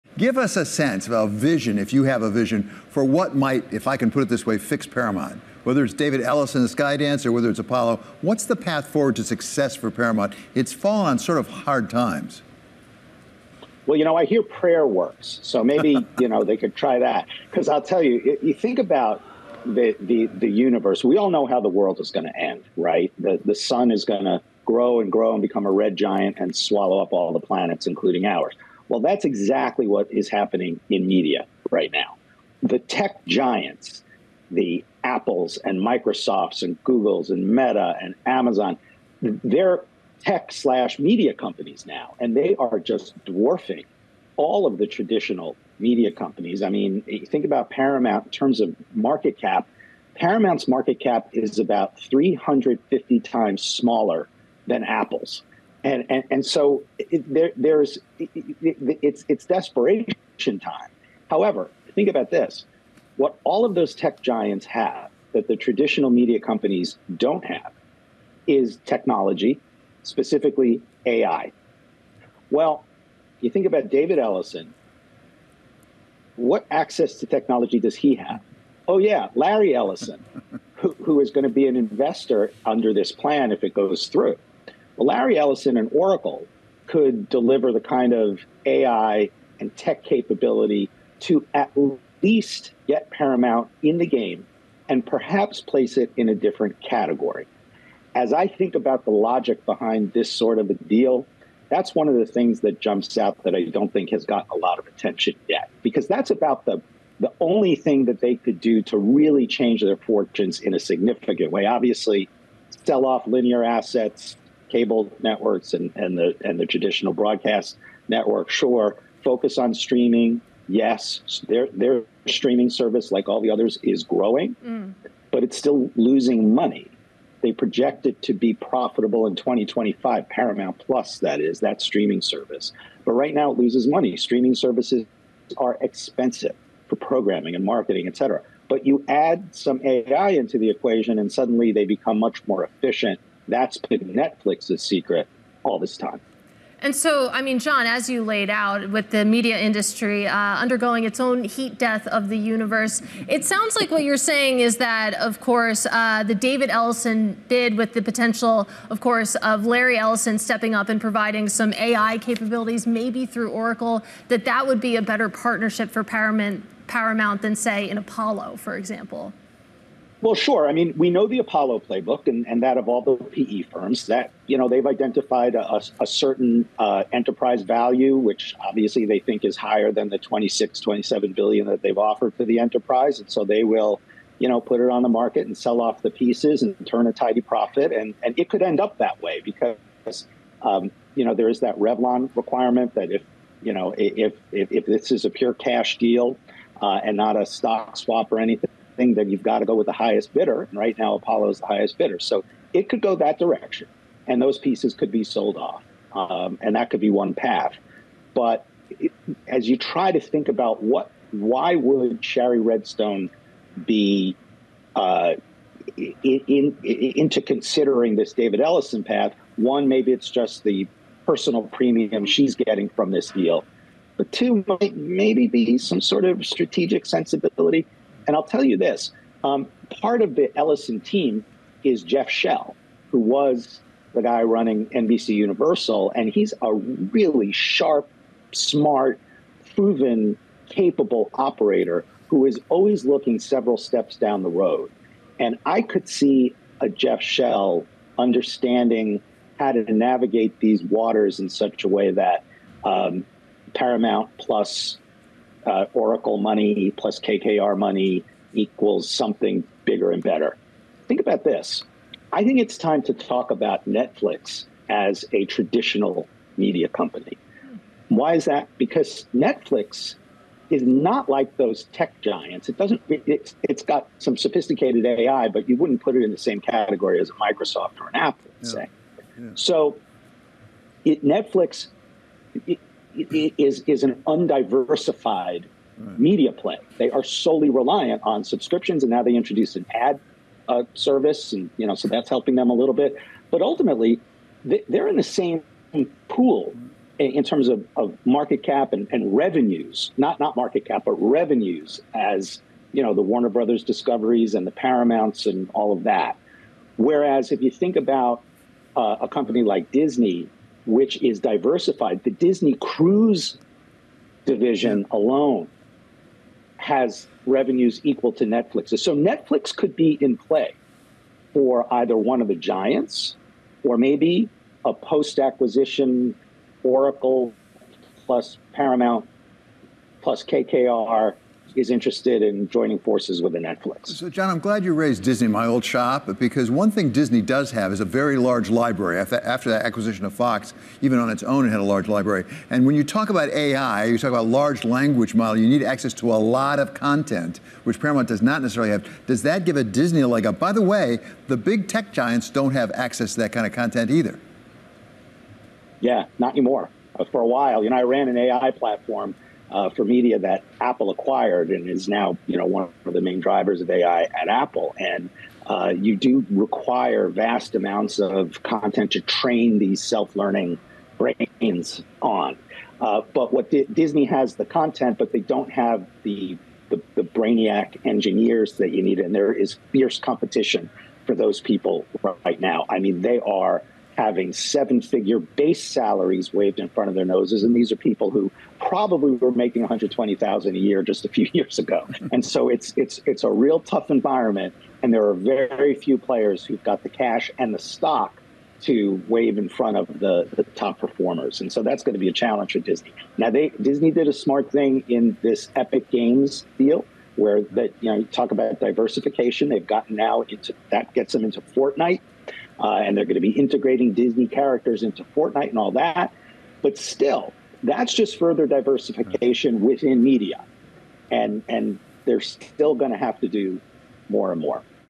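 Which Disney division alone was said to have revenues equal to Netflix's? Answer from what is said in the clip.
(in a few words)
Disney Cruise division.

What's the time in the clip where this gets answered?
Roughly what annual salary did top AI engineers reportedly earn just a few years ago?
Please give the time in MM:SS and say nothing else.
06:29.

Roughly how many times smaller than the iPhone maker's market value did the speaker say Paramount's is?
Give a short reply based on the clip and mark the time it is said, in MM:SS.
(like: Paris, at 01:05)
350, at 00:51.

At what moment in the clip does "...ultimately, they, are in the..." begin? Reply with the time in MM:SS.
04:53.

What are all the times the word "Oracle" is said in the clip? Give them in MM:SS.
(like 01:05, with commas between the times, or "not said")
01:25, 02:43, 04:15, 05:26.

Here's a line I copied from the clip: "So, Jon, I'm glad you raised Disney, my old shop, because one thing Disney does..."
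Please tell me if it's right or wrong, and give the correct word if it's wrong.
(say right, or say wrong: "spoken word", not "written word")
right.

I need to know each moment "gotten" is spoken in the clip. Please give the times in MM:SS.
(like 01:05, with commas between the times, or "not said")
01:44, 06:49.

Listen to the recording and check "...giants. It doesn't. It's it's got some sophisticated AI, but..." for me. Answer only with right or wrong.
right.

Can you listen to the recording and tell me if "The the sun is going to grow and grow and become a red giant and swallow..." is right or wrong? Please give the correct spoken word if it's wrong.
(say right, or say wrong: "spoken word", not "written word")
right.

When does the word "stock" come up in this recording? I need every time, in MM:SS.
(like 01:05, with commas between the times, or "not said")
03:17, 06:37.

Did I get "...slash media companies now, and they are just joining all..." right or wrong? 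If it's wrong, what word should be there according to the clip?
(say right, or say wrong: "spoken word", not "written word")
wrong: "dwarfing", not "joining".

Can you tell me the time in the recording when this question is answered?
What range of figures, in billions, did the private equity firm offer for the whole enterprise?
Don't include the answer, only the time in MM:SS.
03:00.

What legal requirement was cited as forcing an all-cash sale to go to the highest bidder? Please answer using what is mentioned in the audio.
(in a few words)
Revlon requirement.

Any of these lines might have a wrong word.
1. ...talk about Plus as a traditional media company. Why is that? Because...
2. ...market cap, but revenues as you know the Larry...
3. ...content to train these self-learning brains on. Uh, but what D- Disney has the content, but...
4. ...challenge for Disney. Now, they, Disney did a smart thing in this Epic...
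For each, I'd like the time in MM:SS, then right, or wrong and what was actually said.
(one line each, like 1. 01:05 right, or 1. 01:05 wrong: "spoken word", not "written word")
1. 04:23 wrong: "Netflix", not "Plus"
2. 05:00 wrong: "Warner", not "Larry"
3. 06:08 right
4. 06:42 right.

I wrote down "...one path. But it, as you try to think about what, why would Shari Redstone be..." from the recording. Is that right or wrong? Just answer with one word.
right.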